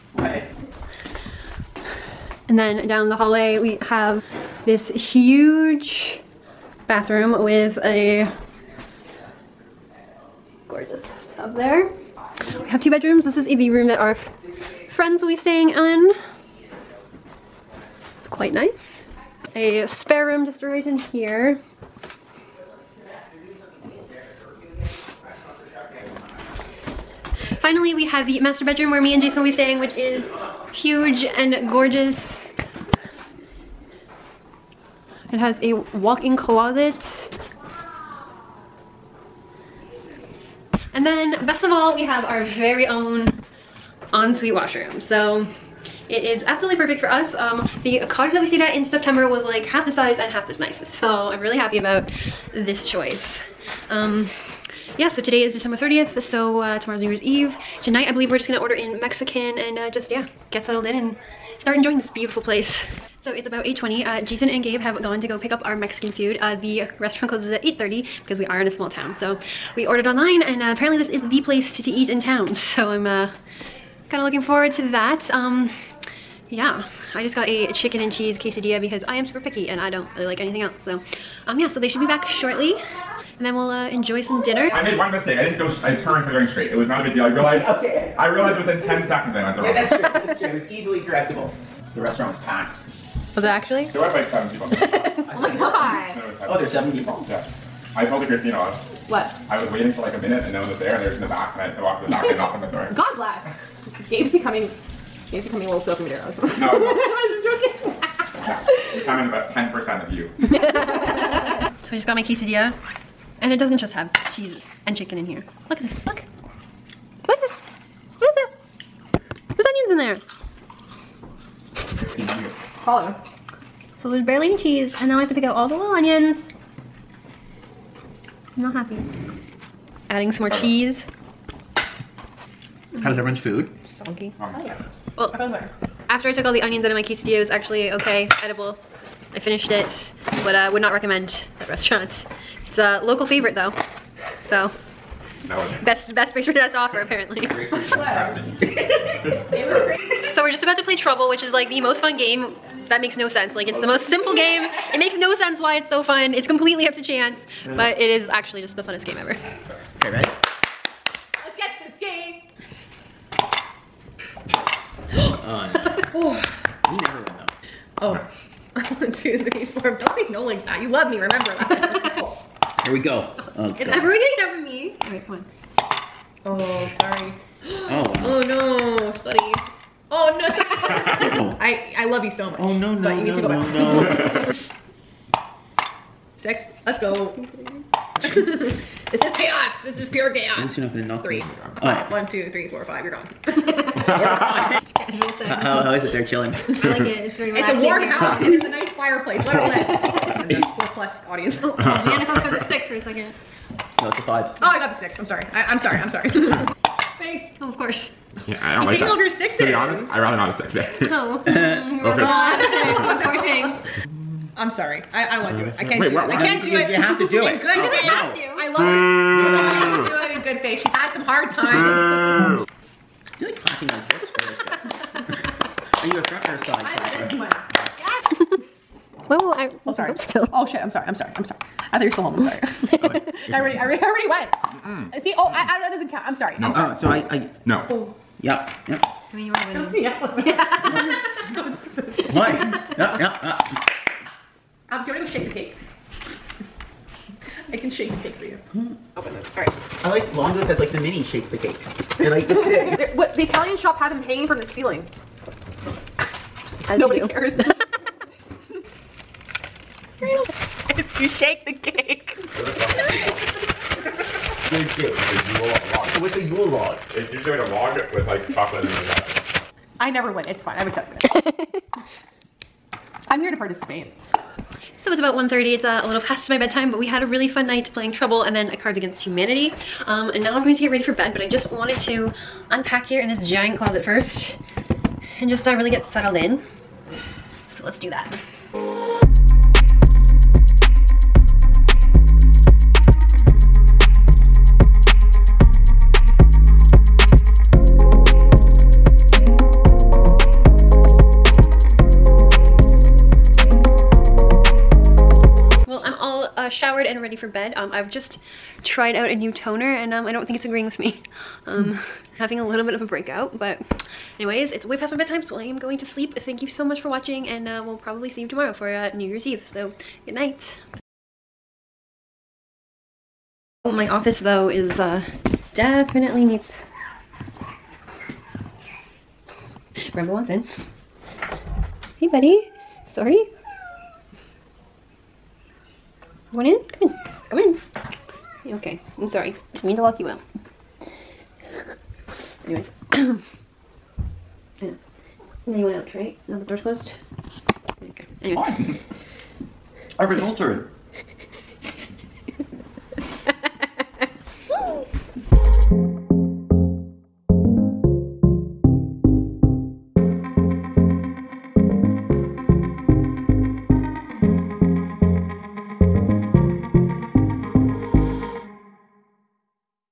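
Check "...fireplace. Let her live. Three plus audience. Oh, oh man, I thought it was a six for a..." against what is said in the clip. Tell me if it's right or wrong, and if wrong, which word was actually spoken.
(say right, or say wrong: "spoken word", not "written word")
wrong: "Four", not "Three".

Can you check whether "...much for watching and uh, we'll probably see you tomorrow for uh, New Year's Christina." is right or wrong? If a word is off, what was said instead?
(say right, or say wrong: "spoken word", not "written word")
wrong: "Eve", not "Christina".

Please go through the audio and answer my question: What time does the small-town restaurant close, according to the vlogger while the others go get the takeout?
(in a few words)
8:30.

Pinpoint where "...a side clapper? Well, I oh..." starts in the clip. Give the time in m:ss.
3:46.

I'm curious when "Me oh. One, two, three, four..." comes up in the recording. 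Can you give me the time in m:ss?
3:11.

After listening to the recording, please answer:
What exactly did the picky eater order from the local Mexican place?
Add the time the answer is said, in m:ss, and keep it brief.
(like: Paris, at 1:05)
Chicken and cheese quesadilla, at 1:17.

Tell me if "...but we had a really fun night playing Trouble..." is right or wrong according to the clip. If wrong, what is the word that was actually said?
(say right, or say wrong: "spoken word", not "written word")
right.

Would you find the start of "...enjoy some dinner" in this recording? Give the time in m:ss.
1:23.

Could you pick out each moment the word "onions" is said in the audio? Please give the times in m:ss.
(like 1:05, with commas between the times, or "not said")
1:59, 2:05, 2:16.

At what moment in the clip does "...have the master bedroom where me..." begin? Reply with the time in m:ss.
0:28.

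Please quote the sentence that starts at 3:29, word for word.
You over six To be honest, I rather not have sex there.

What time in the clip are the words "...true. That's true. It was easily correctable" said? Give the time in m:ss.
1:29.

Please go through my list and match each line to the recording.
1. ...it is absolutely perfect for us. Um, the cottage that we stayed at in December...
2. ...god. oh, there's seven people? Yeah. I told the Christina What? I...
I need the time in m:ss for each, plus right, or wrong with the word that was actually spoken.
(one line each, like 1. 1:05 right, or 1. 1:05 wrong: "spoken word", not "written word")
1. 0:46 wrong: "September", not "December"
2. 1:35 right.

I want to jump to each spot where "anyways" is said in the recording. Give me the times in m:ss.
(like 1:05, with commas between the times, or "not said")
5:14, 5:42, 5:48.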